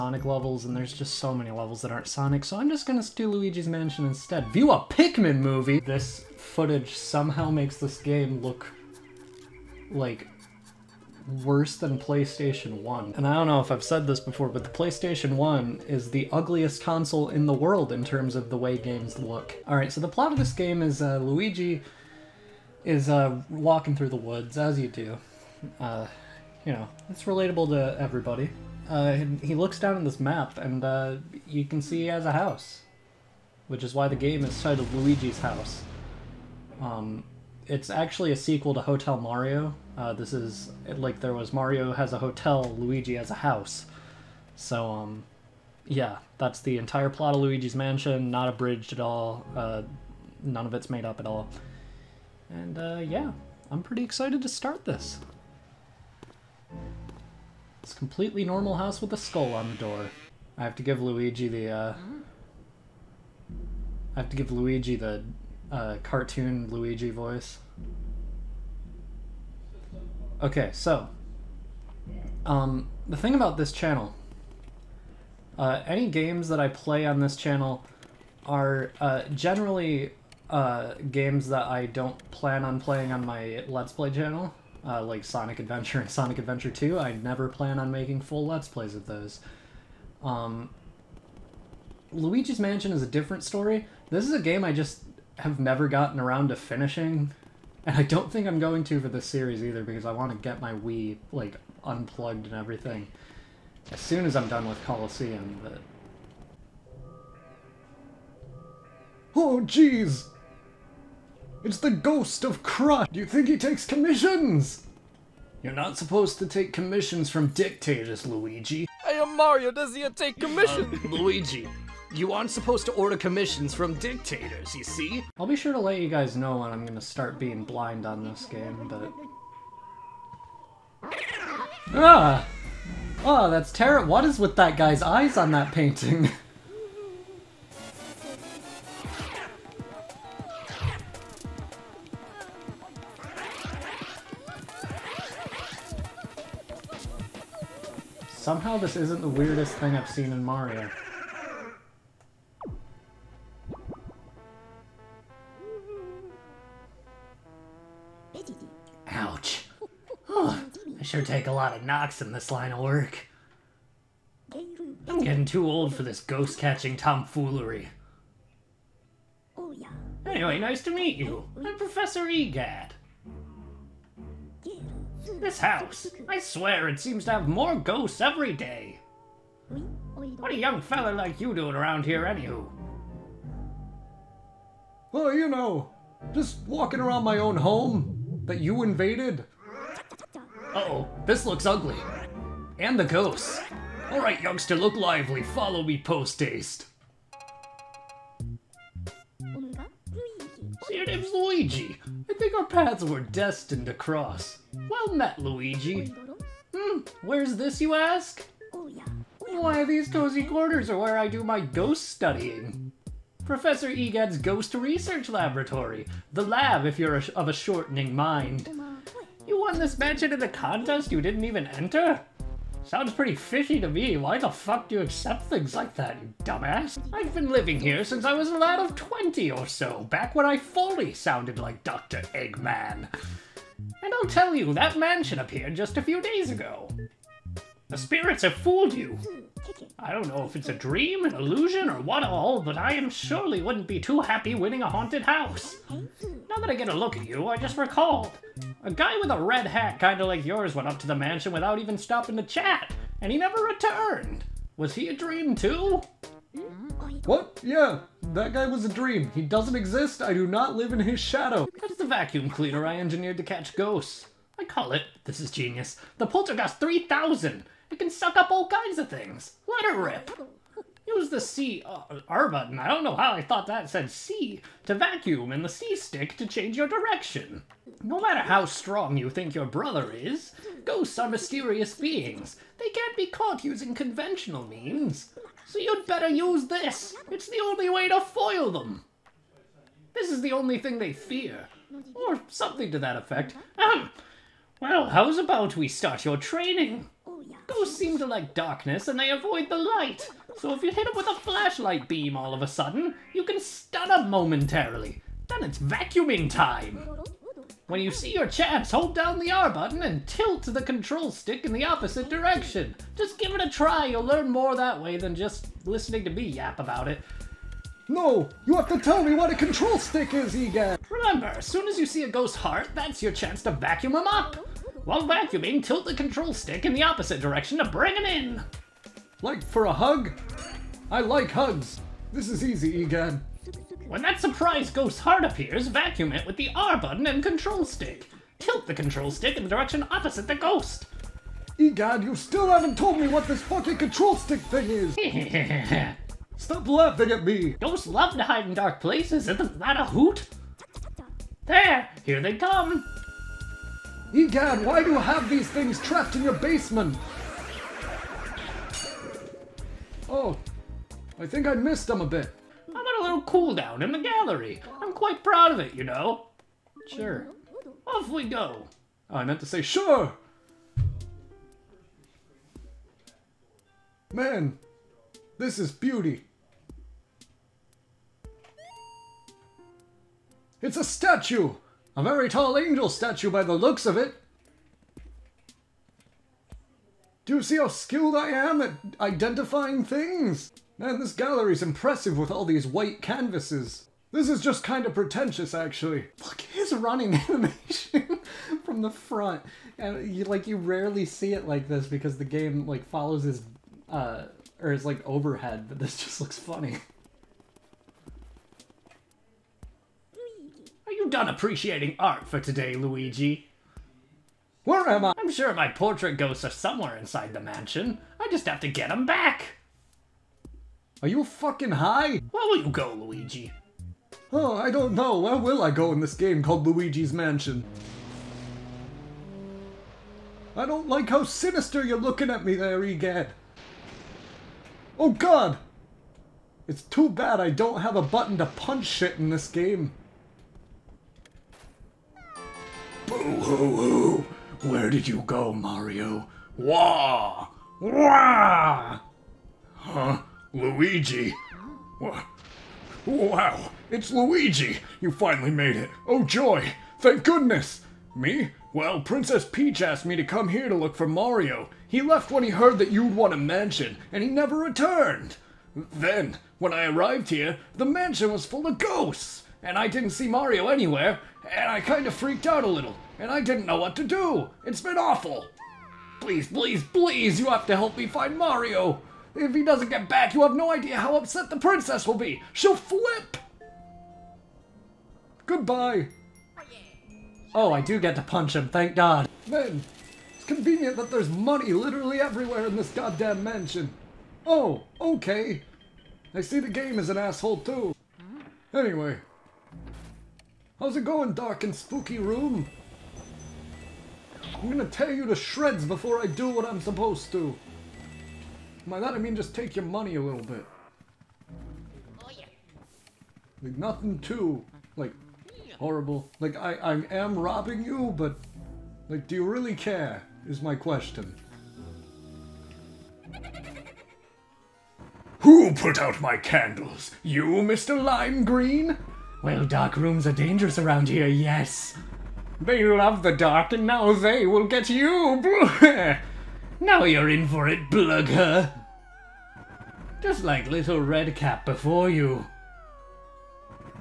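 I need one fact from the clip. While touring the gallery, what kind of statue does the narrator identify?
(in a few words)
angel statue.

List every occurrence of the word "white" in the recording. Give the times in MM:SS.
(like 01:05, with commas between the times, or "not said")
06:32.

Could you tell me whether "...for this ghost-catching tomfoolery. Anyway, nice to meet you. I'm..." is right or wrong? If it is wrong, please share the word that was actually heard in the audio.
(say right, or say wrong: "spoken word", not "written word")
right.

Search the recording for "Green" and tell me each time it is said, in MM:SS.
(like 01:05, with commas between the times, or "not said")
08:48.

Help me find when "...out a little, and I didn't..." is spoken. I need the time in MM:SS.
07:52.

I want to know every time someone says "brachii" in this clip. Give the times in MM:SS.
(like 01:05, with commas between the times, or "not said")
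not said.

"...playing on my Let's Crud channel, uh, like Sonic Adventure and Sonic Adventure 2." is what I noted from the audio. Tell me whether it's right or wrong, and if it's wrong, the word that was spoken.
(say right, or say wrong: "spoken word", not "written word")
wrong: "Play", not "Crud".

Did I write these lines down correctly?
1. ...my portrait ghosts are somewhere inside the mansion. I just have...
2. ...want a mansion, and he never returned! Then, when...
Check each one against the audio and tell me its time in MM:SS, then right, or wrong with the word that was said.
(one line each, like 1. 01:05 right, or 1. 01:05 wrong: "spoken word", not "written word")
1. 06:55 right
2. 07:43 right.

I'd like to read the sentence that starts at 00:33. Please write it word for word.
Which is why the game is titled Luigi's House.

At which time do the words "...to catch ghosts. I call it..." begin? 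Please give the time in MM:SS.
04:23.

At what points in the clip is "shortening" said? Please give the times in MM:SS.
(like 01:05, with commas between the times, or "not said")
03:37.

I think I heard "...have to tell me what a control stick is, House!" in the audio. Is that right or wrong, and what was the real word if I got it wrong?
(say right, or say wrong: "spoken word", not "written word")
wrong: "Egad", not "House".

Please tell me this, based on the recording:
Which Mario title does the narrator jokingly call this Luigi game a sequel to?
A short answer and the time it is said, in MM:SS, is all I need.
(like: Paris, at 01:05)
Hotel Mario, at 00:38.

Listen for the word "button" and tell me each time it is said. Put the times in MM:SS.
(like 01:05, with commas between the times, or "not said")
04:32, 05:09, 05:36, 07:18.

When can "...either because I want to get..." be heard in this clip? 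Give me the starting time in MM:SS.
01:39.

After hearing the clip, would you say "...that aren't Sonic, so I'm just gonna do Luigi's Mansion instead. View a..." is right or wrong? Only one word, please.
right.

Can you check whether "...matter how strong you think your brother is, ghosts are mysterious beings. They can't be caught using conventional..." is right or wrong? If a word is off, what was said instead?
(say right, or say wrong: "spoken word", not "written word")
right.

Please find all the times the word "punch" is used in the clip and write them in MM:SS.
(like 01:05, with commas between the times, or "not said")
07:18, 08:08.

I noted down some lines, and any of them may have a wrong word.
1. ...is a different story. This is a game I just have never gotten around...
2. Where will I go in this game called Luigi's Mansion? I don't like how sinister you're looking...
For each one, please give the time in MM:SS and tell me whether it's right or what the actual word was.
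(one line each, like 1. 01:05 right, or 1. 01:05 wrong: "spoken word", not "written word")
1. 01:32 right
2. 07:05 right.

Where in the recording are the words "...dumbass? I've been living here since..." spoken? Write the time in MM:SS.
03:46.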